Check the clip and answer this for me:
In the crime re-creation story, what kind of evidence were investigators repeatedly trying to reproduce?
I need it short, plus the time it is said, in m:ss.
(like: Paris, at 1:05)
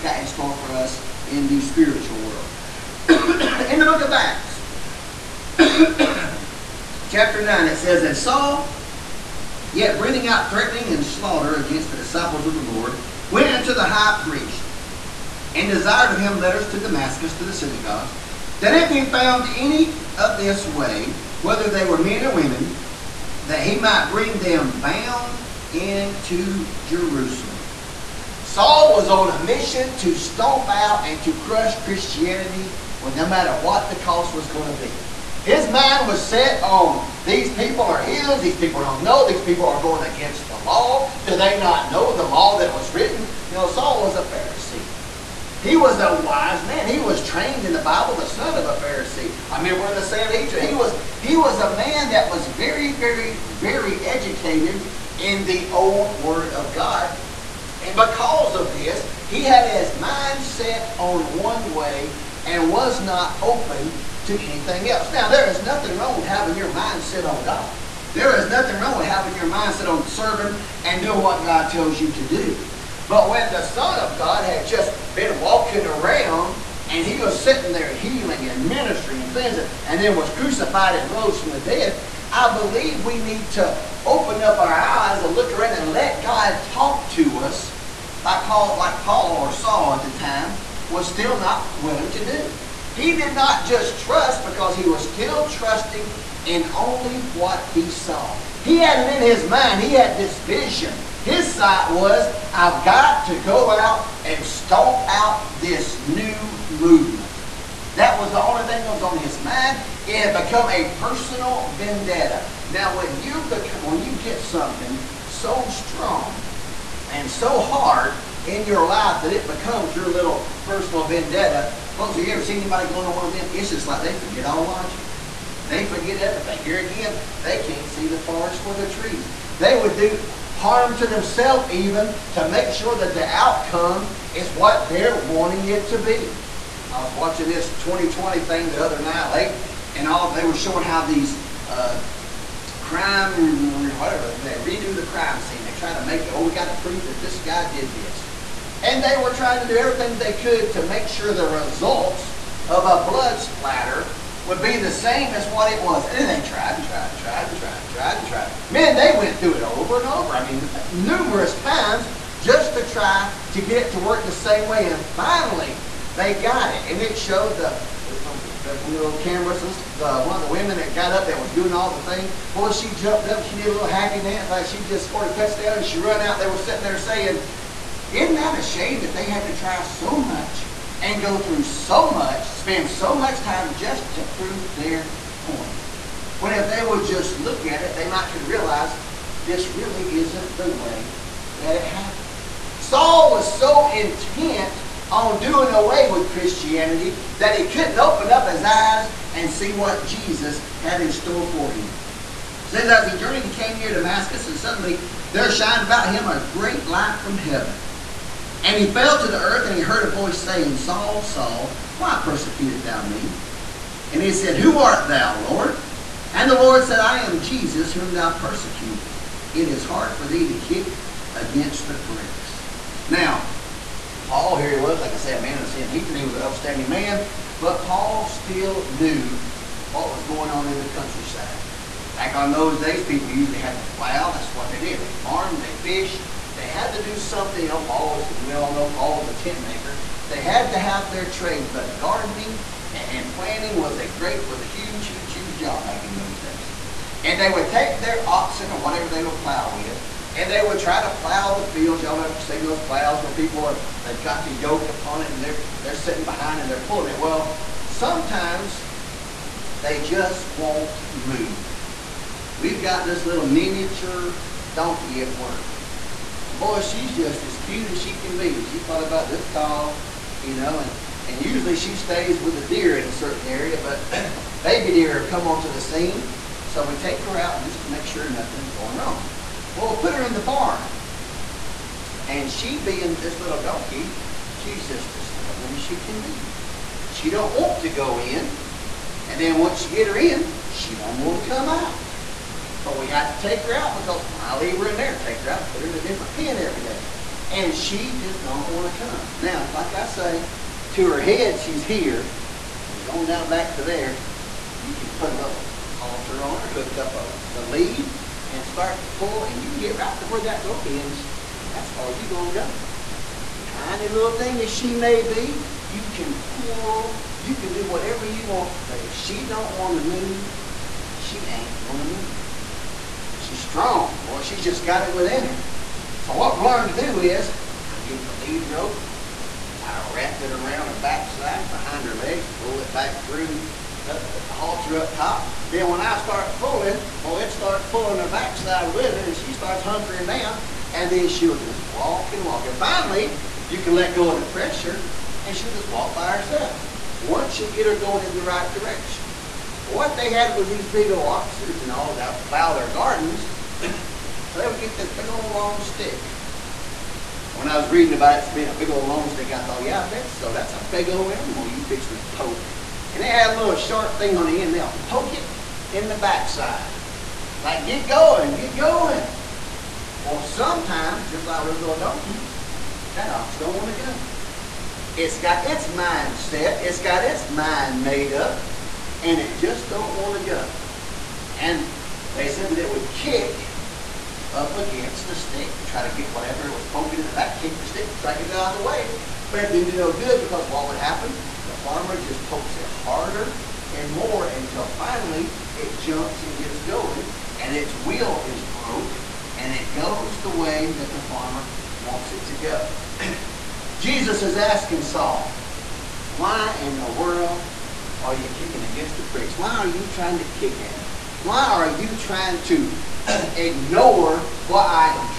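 Blood splatter, at 2:33.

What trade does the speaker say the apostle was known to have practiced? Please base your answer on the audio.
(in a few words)
Tent maker.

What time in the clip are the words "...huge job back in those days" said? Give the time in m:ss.
4:05.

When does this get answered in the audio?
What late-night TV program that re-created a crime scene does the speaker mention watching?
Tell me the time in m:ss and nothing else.
2:17.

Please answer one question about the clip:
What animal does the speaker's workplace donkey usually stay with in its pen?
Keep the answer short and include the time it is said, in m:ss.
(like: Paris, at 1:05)
A deer, at 4:32.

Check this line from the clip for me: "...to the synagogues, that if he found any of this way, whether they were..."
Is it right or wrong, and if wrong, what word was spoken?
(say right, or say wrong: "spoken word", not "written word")
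right.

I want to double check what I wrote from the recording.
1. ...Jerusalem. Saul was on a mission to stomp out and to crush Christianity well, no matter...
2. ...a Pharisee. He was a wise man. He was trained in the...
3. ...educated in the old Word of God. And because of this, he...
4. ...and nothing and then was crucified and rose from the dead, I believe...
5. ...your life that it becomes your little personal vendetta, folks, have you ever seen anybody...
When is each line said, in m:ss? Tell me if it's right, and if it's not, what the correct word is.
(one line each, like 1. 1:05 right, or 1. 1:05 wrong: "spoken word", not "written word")
1. 0:26 right
2. 0:44 right
3. 0:54 right
4. 1:19 wrong: "cleansing", not "nothing"
5. 1:58 right.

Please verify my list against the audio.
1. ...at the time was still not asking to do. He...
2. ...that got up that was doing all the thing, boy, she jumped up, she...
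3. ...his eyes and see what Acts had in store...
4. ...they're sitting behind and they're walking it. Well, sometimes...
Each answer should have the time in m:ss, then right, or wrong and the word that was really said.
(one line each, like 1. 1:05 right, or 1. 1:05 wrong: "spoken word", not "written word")
1. 1:29 wrong: "willing", not "asking"
2. 2:50 right
3. 3:18 wrong: "Jesus", not "Acts"
4. 4:15 wrong: "pulling", not "walking".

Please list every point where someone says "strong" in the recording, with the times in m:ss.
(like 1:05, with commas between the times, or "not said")
1:55, 5:23.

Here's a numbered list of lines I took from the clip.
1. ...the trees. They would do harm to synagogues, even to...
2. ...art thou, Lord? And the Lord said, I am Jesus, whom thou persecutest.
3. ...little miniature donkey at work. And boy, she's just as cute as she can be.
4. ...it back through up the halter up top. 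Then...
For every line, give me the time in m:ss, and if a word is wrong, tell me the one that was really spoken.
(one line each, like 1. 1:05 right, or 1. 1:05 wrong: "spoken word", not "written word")
1. 2:08 wrong: "themselves", not "synagogues"
2. 3:34 right
3. 4:23 right
4. 5:32 right.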